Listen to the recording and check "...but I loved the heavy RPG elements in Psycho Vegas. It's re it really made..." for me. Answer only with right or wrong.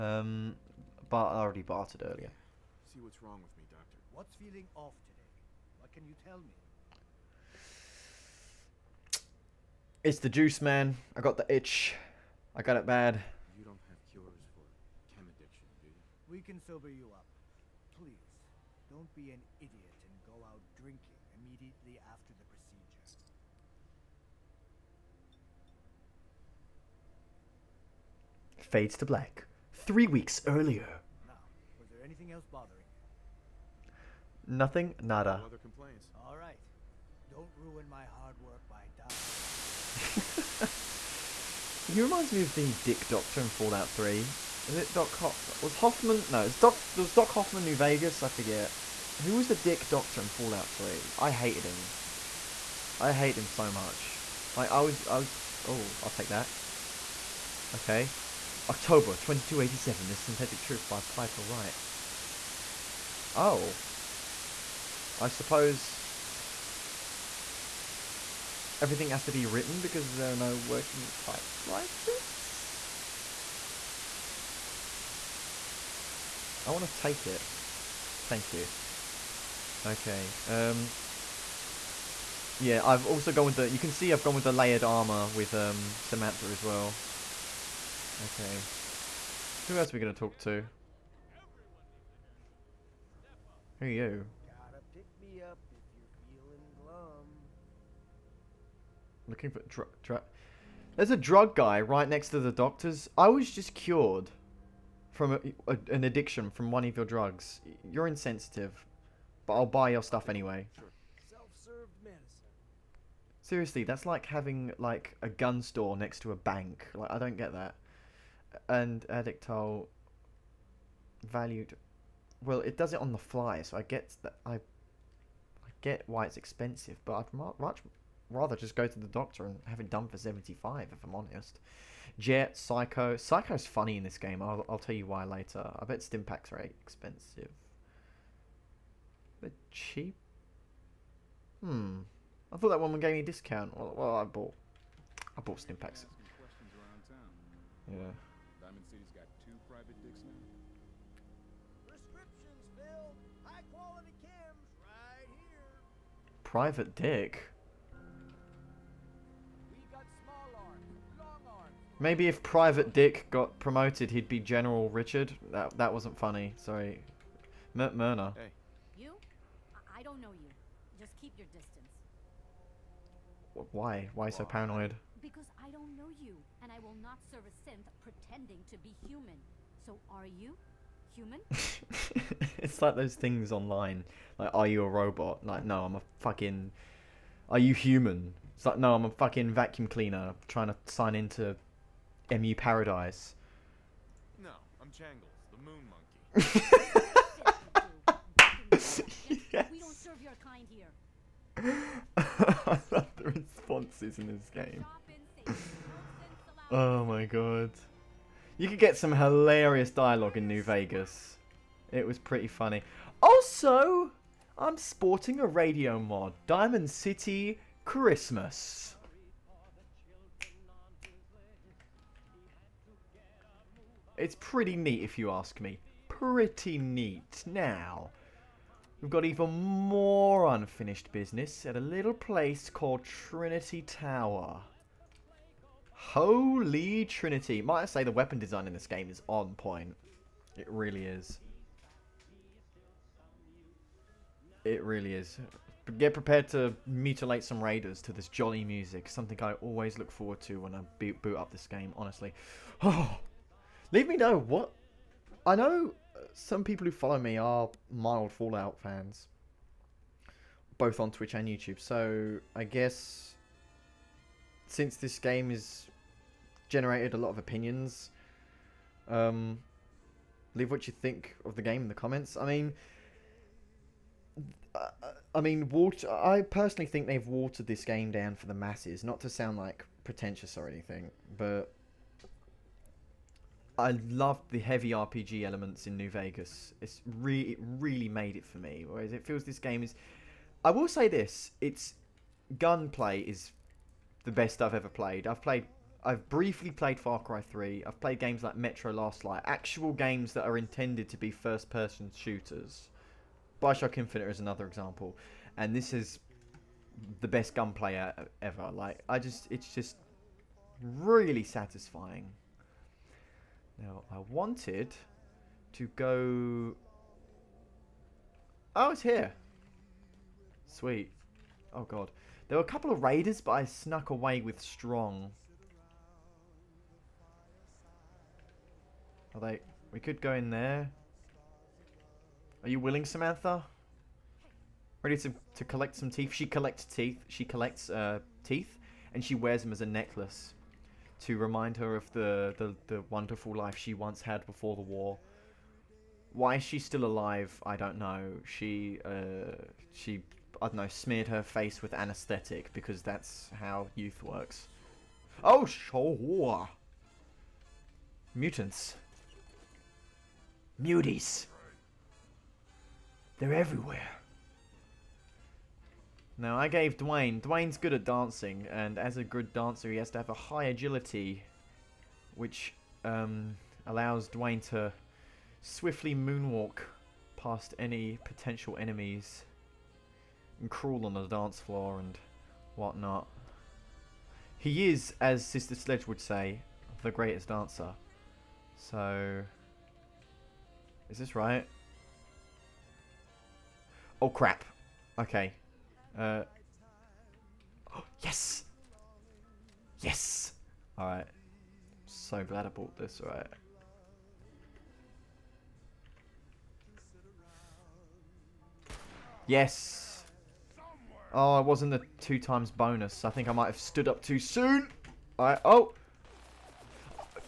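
wrong.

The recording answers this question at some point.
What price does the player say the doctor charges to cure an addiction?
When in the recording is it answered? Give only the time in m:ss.
2:10.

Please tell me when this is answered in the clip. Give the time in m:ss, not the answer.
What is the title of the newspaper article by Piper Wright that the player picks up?
1:00.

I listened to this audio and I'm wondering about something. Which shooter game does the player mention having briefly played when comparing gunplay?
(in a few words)
Far Cry 3.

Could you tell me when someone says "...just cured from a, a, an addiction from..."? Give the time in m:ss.
1:43.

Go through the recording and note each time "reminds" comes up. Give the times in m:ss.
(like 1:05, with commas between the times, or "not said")
0:41, 5:41.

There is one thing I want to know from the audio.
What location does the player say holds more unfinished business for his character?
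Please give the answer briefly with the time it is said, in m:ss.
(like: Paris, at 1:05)
Trinity Tower, at 3:53.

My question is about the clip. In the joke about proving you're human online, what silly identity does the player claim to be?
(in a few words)
Jangles, the moon monkey.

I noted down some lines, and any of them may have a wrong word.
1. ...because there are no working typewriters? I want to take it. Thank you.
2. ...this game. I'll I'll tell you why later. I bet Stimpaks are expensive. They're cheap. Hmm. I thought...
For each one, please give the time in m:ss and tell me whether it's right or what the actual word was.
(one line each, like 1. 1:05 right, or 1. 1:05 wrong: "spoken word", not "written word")
1. 1:09 right
2. 2:14 right.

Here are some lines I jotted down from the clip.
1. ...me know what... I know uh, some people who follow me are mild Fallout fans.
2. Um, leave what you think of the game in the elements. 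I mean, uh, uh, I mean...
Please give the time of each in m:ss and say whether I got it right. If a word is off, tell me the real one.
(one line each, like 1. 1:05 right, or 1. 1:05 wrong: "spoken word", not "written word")
1. 4:14 right
2. 4:29 wrong: "comments", not "elements".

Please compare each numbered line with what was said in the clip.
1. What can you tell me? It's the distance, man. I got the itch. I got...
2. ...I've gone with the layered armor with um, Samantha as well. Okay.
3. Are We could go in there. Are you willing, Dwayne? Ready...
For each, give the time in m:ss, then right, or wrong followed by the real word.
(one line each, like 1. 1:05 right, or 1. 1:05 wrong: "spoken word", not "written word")
1. 0:05 wrong: "juice", not "distance"
2. 1:24 right
3. 5:29 wrong: "Samantha", not "Dwayne".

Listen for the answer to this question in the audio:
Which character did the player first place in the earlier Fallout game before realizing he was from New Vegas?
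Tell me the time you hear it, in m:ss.
0:47.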